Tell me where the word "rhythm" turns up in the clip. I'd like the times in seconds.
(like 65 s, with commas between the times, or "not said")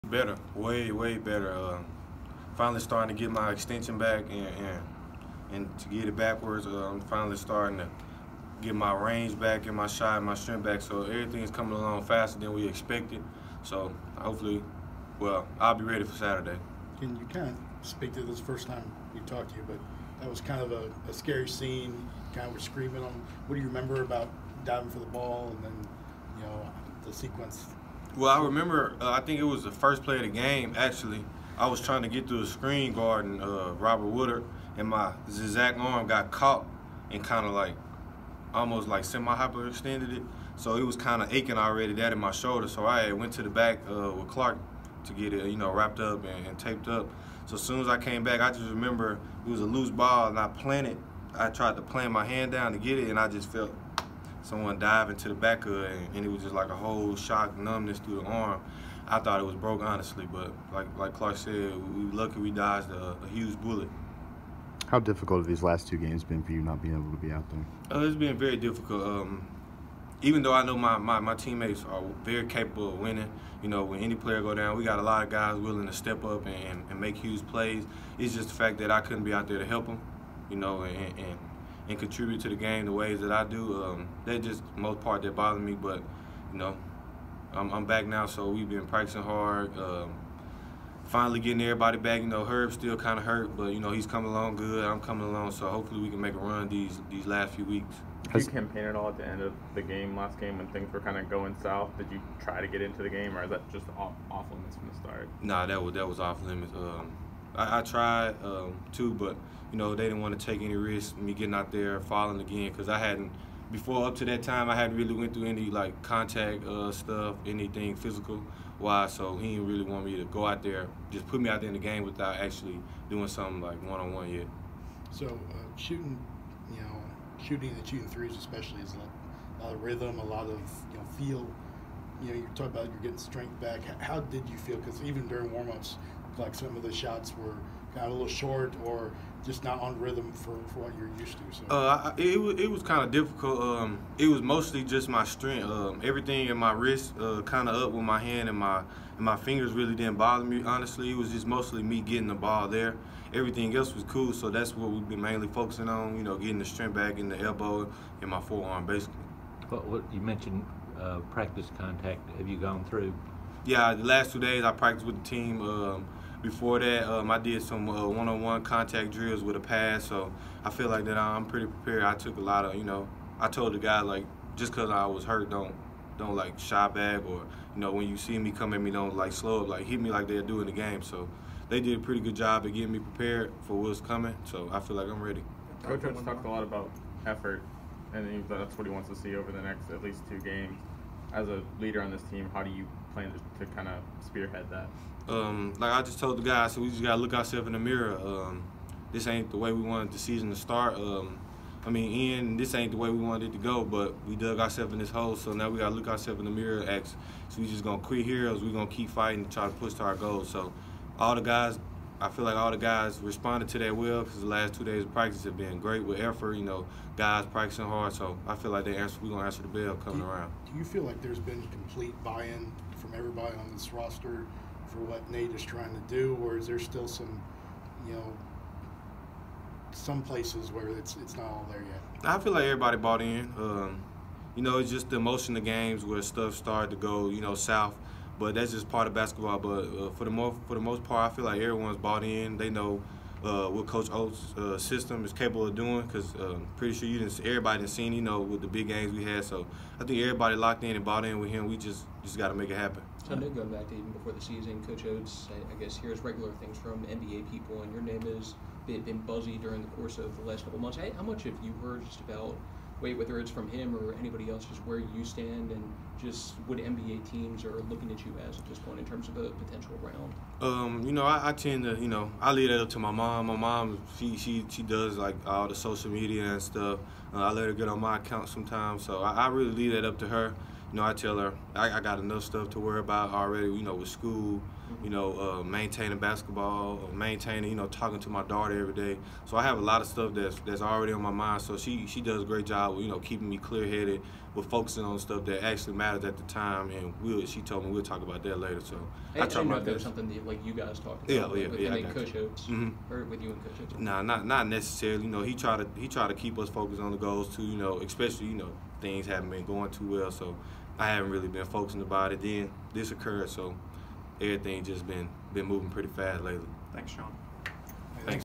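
129 s, 139 s.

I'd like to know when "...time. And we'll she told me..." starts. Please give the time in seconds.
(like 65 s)
296 s.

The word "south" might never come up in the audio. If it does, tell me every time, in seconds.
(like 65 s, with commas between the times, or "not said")
101 s, 237 s.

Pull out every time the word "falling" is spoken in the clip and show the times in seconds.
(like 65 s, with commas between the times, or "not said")
112 s.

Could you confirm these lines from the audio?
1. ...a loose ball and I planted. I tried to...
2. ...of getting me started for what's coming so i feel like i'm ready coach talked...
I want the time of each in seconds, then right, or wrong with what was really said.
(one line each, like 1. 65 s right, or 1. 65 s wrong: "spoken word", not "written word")
1. 49 s right
2. 182 s wrong: "prepared", not "started".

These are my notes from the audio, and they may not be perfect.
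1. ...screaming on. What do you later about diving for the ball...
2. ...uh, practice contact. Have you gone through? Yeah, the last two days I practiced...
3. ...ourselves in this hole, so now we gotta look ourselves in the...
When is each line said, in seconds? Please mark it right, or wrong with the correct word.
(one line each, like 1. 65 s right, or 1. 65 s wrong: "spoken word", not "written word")
1. 22 s wrong: "remember", not "later"
2. 160 s right
3. 204 s right.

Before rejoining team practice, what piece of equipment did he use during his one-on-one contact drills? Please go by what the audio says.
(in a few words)
A pad.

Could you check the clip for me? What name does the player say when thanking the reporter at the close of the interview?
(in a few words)
Sean.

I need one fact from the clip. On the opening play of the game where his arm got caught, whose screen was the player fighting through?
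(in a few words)
Robert Woodard.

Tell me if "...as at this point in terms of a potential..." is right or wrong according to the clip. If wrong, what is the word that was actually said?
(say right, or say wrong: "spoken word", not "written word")
right.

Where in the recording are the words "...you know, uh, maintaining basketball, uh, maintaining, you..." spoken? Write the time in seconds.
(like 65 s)
285 s.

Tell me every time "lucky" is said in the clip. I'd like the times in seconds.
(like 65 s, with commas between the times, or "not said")
62 s.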